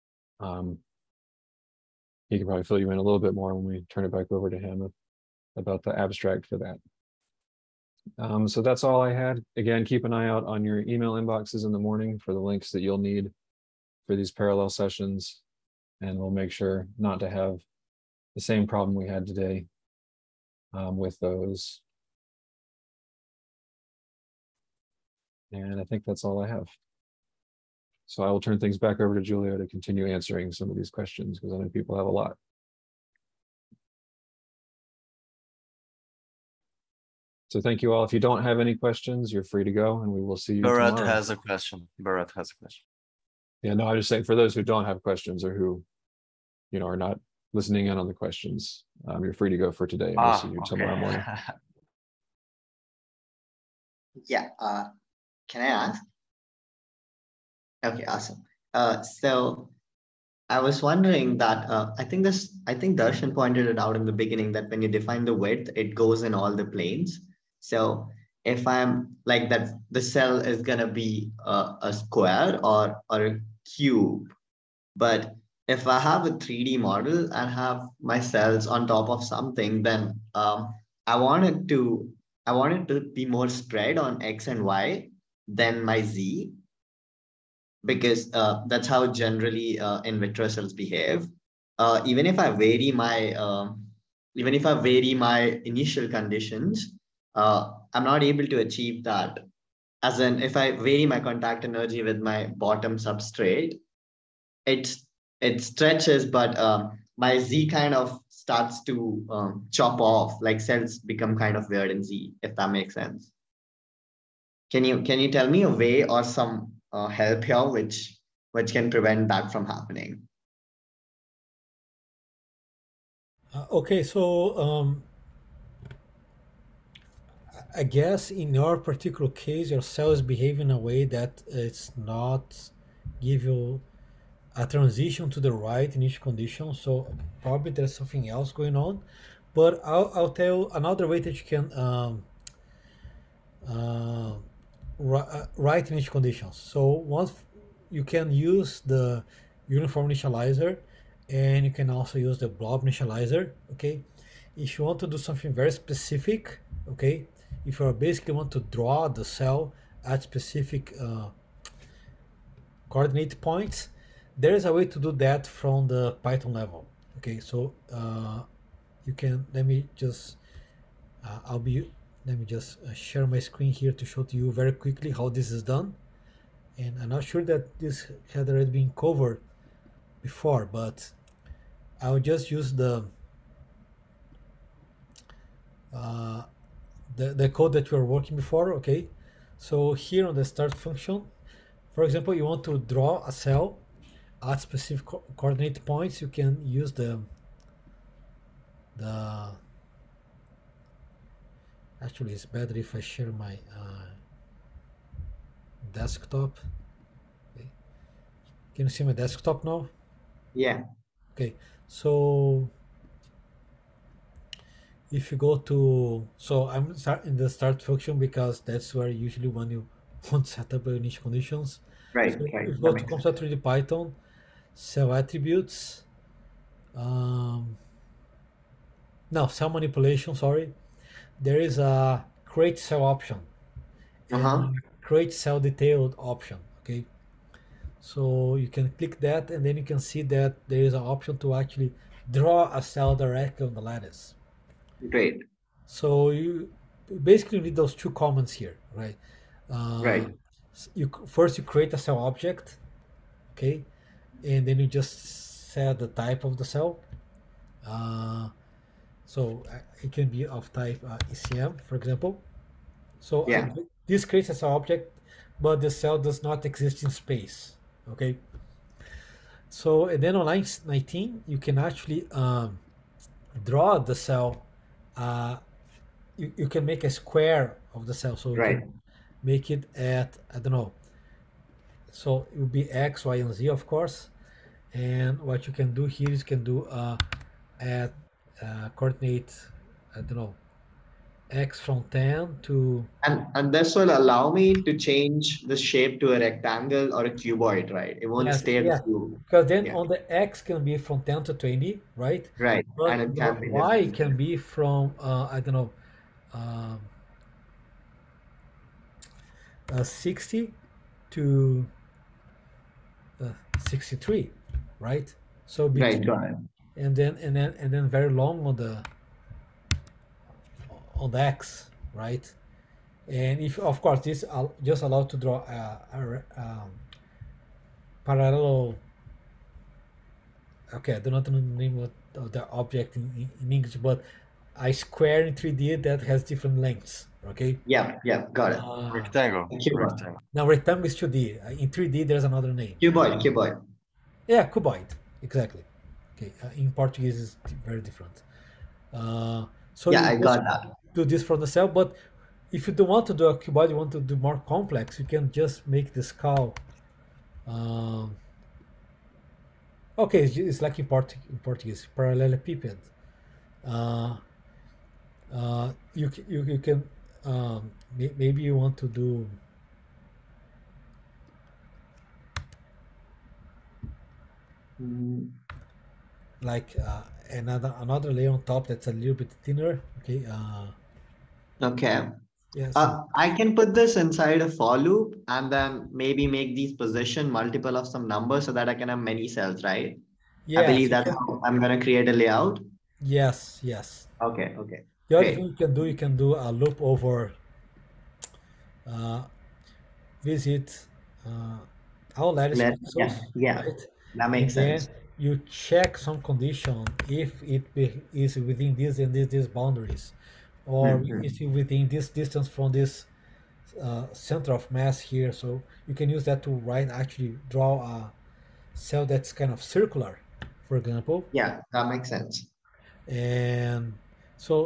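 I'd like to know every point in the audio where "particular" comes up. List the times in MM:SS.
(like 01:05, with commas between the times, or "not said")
02:08.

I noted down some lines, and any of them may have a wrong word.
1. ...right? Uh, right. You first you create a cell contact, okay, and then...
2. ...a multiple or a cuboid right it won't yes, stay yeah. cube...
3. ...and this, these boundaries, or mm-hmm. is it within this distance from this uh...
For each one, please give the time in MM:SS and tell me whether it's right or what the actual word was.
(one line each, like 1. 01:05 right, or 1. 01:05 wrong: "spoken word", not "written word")
1. 04:08 wrong: "object", not "contact"
2. 04:56 wrong: "rectangle", not "multiple"
3. 06:49 right.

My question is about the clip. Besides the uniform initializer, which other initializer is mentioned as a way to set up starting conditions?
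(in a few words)
blob initializer.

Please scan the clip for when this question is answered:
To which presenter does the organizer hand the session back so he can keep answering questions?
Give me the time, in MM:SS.
00:29.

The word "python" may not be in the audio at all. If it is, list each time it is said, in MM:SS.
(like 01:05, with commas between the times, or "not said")
02:46, 03:43.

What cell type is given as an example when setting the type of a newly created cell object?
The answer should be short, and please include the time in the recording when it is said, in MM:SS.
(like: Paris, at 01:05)
ECM, at 04:21.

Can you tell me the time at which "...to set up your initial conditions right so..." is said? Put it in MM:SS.
03:40.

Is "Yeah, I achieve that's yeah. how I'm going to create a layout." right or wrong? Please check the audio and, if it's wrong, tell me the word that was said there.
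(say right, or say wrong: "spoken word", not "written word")
wrong: "believe", not "achieve".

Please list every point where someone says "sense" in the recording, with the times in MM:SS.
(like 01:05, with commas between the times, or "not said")
01:52, 06:45, 07:02.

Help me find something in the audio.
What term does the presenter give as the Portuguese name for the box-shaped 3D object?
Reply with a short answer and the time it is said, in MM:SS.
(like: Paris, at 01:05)
parallelepiped, at 06:02.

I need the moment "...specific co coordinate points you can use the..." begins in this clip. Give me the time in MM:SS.
03:14.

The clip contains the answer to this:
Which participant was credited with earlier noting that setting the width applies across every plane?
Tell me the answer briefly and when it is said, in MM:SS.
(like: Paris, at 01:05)
Darshan, at 01:02.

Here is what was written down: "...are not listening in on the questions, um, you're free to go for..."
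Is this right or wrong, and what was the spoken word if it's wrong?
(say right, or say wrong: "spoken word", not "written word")
right.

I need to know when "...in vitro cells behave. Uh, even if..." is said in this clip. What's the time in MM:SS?
01:30.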